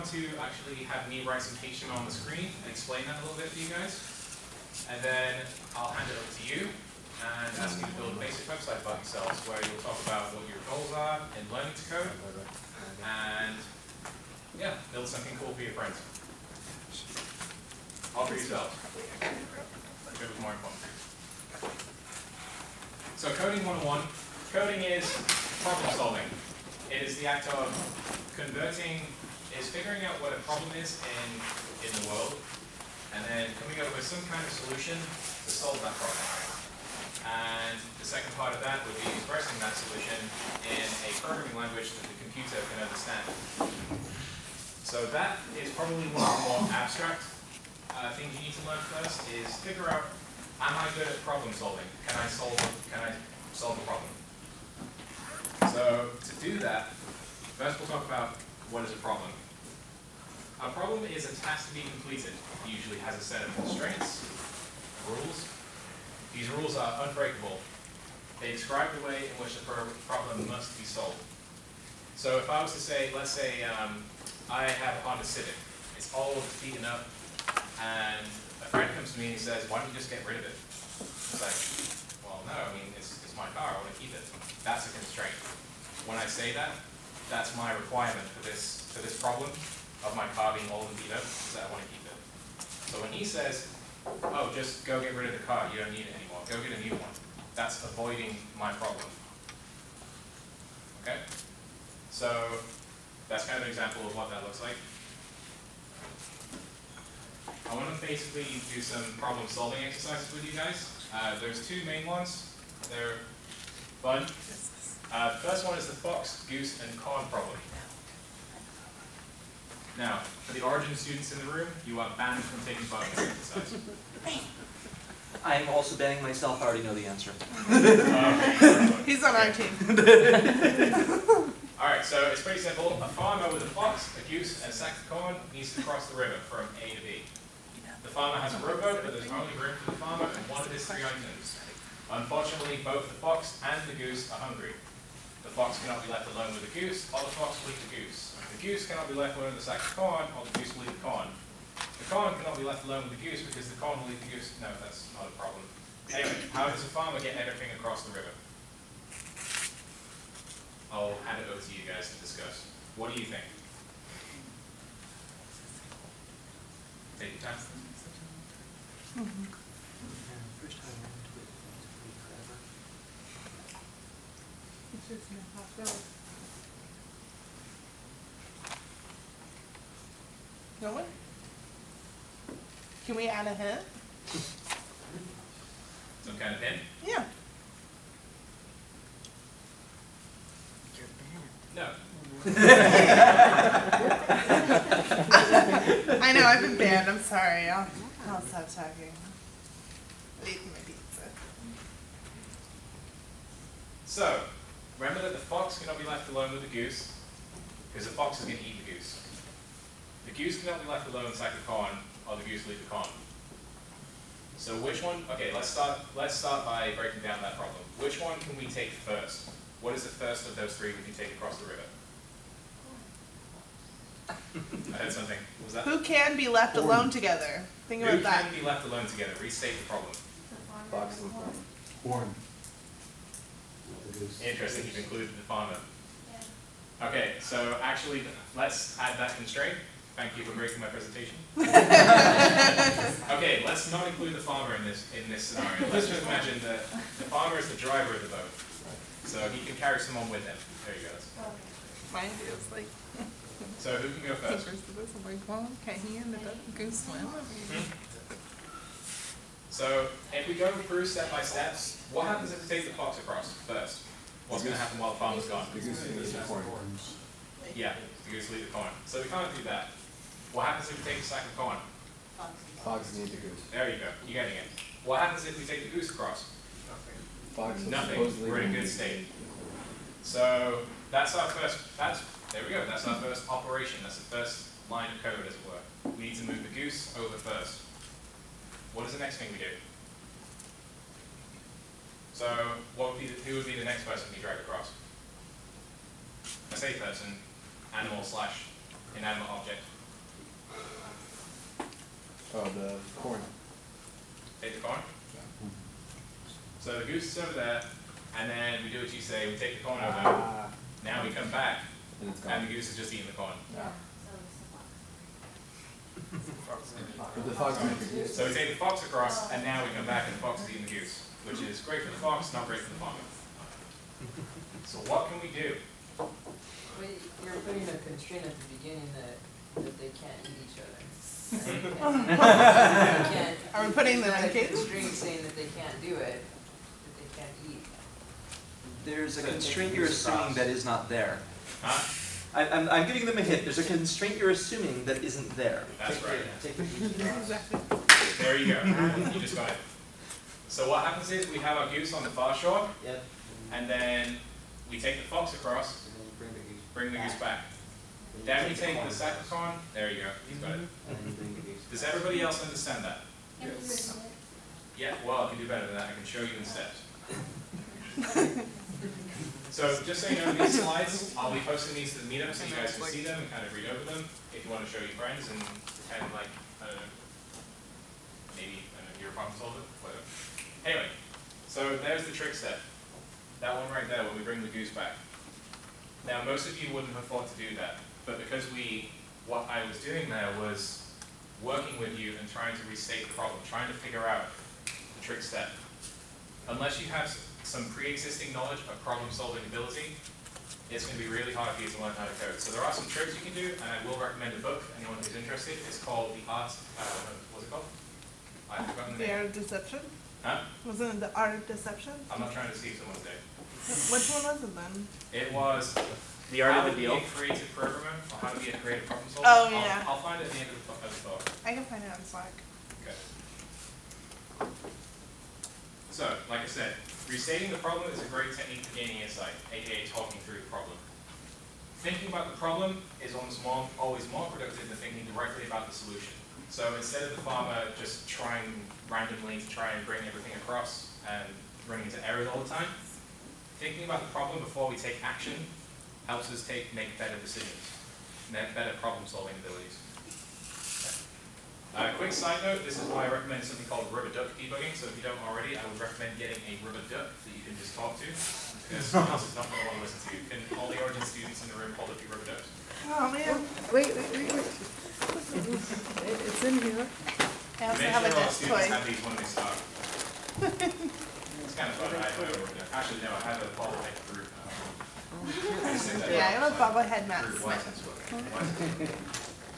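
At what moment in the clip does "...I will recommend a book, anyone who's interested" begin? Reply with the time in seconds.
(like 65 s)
403 s.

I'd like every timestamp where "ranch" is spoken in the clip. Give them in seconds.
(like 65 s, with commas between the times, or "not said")
not said.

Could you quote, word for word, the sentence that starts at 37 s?
And the second part of that would be expressing that solution in a programming language that the computer can understand.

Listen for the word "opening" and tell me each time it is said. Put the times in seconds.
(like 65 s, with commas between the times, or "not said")
not said.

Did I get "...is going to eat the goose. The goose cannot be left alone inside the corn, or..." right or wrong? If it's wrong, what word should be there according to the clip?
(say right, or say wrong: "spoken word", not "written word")
right.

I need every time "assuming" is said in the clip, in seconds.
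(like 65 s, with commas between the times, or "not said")
340 s, 344 s.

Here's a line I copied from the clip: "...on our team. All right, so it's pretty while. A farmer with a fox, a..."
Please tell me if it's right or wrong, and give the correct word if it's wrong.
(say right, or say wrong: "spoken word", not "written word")
wrong: "simple", not "while".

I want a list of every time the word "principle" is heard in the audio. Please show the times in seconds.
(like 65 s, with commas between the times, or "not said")
not said.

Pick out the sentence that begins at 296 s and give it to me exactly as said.
I say person, animal slash inanimate object.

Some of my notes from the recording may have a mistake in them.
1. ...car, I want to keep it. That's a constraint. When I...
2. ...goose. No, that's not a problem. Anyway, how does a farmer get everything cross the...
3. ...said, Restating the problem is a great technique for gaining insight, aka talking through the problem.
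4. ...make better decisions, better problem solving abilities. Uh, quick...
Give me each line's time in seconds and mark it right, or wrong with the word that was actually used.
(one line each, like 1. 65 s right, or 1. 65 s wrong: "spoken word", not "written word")
1. 83 s right
2. 154 s wrong: "across", not "cross"
3. 426 s right
4. 446 s right.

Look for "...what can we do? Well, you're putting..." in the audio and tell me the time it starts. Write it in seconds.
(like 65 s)
325 s.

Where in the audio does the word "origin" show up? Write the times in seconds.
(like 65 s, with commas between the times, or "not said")
120 s, 460 s.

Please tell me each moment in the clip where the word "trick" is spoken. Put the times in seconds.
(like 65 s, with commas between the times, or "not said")
382 s, 395 s, 403 s.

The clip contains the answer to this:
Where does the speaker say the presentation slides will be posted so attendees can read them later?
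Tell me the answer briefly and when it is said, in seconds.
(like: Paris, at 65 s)
the meetup, at 372 s.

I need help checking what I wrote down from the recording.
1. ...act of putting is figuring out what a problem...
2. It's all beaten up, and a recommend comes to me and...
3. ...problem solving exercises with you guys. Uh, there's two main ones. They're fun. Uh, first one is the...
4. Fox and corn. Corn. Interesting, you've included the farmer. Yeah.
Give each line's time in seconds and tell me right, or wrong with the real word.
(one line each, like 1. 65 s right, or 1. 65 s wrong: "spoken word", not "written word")
1. 27 s wrong: "converting", not "putting"
2. 75 s wrong: "friend", not "recommend"
3. 109 s right
4. 230 s right.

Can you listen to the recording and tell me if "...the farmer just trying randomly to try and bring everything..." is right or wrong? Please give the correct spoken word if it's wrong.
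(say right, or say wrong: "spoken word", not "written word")
right.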